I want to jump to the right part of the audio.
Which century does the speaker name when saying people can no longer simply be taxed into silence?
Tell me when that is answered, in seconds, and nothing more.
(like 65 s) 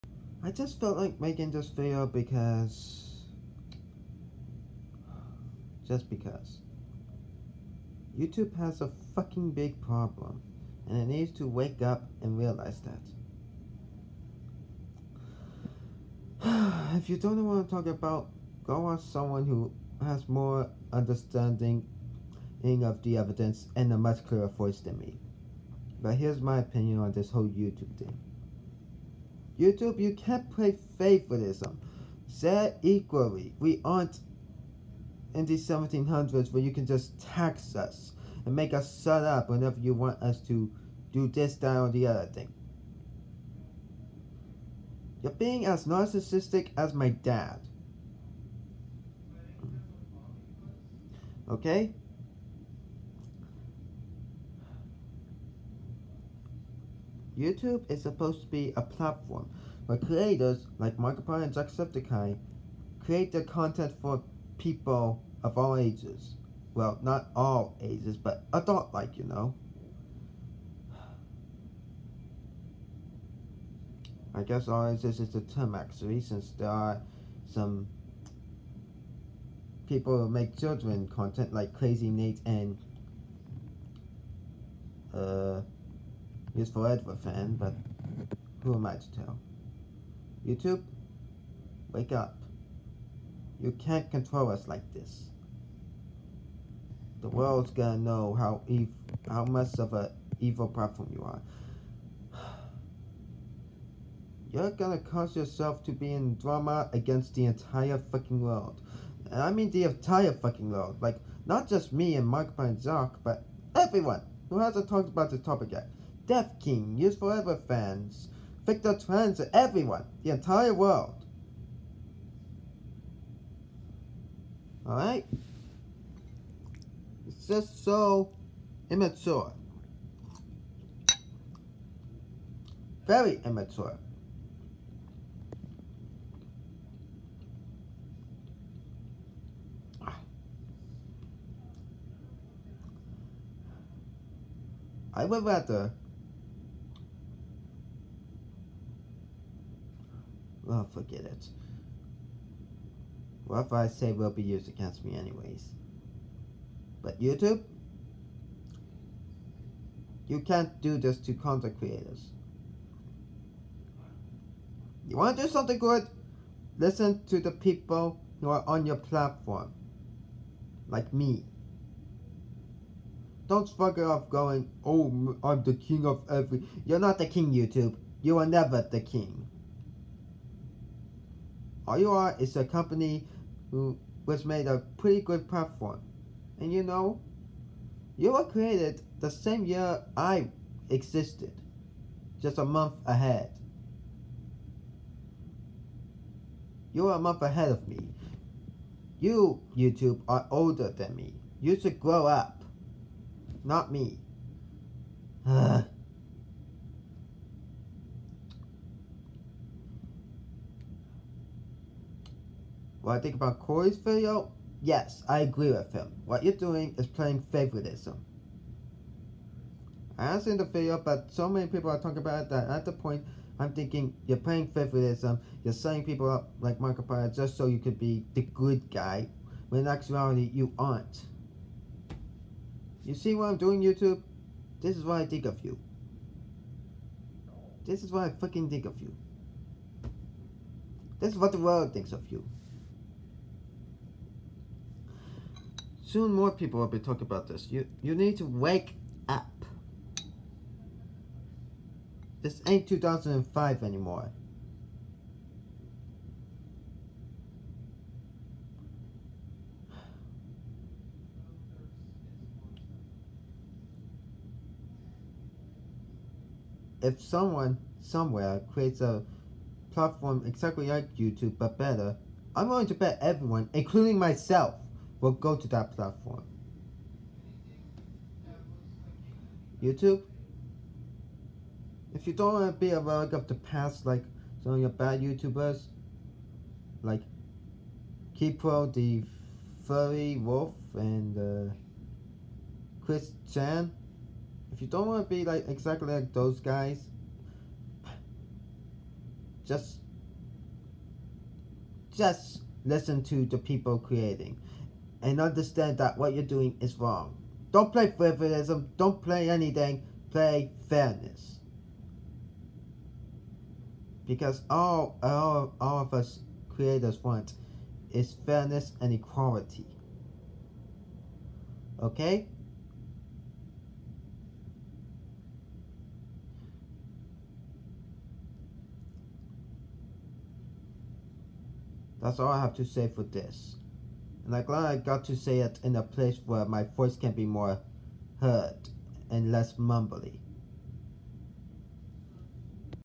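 35 s.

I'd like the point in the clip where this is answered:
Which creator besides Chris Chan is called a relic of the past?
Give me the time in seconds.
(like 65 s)
288 s.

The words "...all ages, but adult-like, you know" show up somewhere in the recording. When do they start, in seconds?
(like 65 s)
67 s.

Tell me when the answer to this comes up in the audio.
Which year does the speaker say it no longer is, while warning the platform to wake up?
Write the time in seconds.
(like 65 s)
252 s.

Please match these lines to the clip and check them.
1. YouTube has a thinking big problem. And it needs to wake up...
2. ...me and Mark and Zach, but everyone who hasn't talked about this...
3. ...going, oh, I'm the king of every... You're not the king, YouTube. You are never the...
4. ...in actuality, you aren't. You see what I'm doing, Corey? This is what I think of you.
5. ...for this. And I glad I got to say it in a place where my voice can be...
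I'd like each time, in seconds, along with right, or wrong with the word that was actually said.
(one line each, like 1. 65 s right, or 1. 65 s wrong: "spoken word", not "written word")
1. 8 s wrong: "fucking", not "thinking"
2. 111 s right
3. 174 s right
4. 229 s wrong: "YouTube", not "Corey"
5. 333 s right.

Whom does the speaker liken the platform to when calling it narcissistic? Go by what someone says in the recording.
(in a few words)
My dad.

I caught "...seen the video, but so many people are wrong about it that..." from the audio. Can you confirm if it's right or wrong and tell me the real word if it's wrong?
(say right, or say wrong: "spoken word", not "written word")
wrong: "talking", not "wrong".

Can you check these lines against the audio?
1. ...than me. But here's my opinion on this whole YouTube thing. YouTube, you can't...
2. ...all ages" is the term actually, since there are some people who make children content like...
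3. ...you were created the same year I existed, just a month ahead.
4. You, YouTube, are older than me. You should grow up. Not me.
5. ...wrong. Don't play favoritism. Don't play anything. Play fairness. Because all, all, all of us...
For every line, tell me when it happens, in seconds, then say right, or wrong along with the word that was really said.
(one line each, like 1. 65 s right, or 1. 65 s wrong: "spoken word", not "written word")
1. 24 s right
2. 74 s right
3. 188 s right
4. 199 s right
5. 306 s right.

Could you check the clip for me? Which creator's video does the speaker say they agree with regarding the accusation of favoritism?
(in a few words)
Corey.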